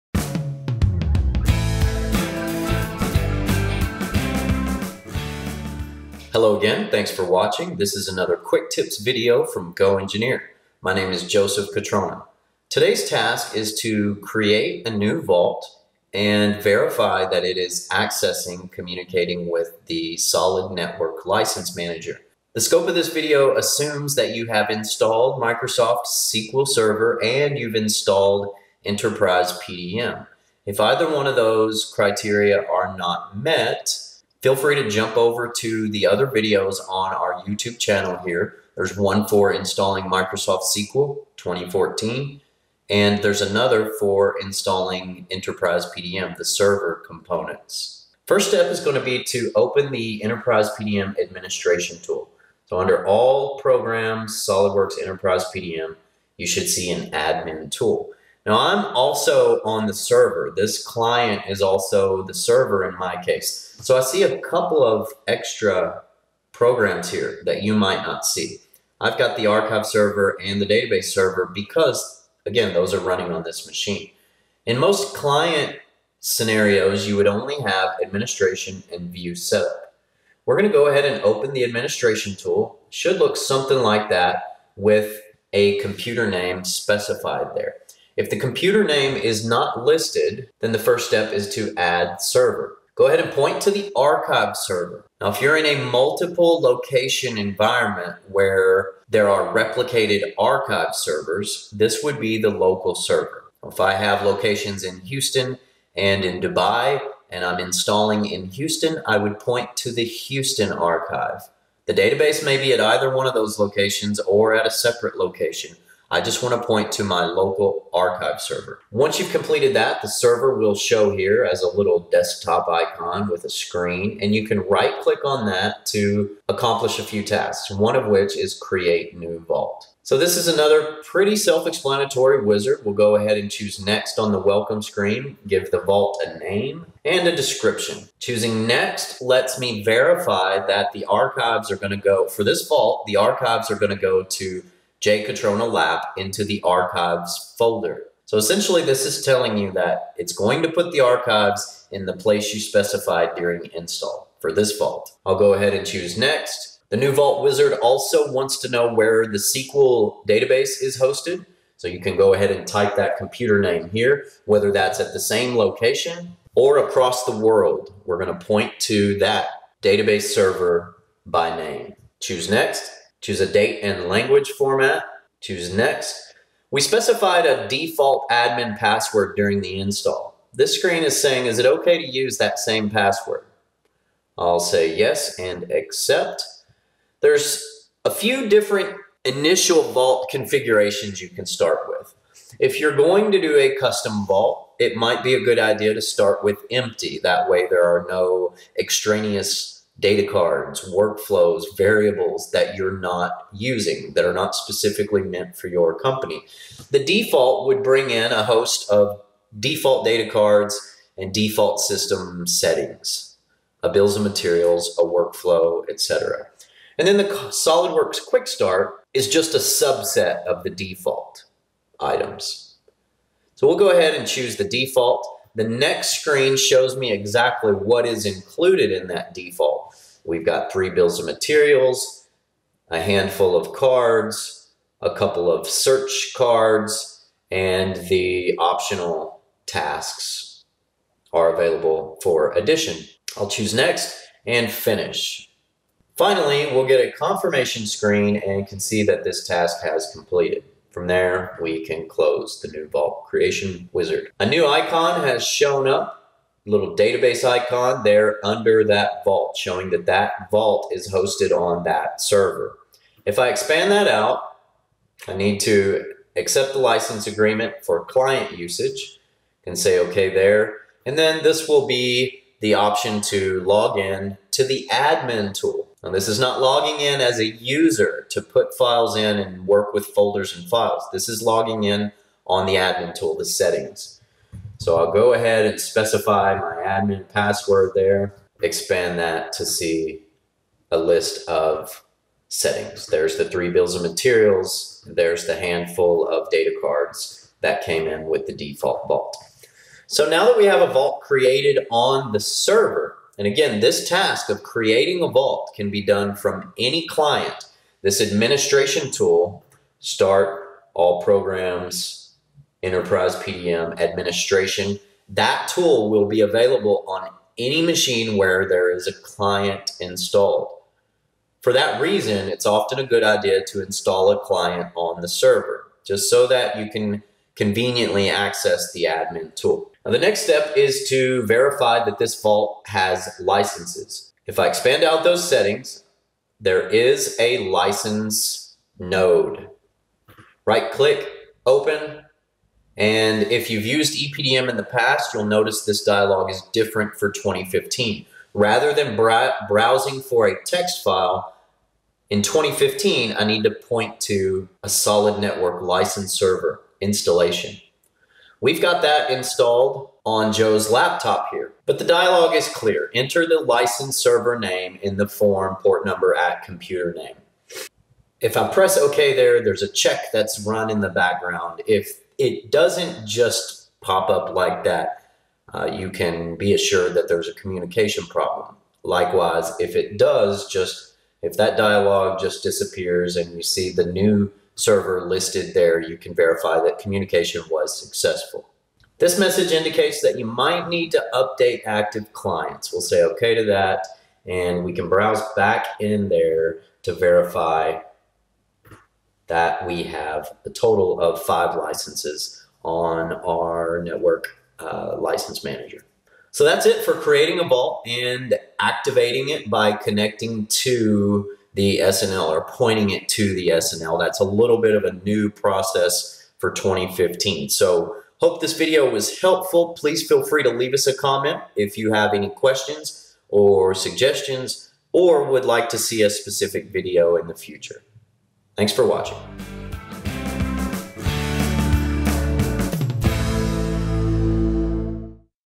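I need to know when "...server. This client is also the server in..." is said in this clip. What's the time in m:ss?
0:59.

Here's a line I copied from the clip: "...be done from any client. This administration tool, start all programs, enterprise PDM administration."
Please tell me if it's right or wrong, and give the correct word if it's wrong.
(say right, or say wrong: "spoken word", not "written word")
right.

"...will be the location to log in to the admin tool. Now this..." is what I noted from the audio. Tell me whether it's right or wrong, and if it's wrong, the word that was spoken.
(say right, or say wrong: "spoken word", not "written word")
wrong: "option", not "location".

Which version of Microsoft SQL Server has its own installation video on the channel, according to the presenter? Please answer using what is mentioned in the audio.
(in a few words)
2014.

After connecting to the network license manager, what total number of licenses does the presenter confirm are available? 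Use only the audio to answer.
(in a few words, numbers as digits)
5.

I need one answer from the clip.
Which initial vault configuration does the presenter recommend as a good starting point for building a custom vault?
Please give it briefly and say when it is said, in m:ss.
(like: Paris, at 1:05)
Empty, at 3:16.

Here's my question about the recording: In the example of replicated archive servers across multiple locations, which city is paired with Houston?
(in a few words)
Dubai.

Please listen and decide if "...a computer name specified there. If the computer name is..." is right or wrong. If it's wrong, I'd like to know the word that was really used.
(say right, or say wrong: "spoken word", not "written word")
right.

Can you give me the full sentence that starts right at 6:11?
If it doesn't just pop up like that.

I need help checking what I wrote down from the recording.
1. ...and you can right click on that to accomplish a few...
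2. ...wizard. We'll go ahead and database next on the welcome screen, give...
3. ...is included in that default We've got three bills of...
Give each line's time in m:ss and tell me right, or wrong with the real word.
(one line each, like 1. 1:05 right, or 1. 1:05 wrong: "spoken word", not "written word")
1. 2:04 right
2. 2:12 wrong: "choose", not "database"
3. 3:48 right.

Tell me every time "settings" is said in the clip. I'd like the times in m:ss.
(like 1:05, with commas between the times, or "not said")
3:32, 4:43, 4:52, 5:35.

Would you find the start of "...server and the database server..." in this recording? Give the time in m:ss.
1:09.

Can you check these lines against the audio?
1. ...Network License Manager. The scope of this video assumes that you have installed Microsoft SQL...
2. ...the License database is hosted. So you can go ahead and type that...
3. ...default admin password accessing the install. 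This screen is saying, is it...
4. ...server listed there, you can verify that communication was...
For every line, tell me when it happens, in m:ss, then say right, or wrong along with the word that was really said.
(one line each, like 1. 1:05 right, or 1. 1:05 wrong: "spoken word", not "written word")
1. 0:20 right
2. 2:39 wrong: "SQL", not "License"
3. 2:57 wrong: "during", not "accessing"
4. 6:24 right.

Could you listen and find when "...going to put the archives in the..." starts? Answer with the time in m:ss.
2:30.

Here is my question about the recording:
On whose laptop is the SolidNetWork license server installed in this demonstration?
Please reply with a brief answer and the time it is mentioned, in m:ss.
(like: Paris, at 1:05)
Joe's, at 6:00.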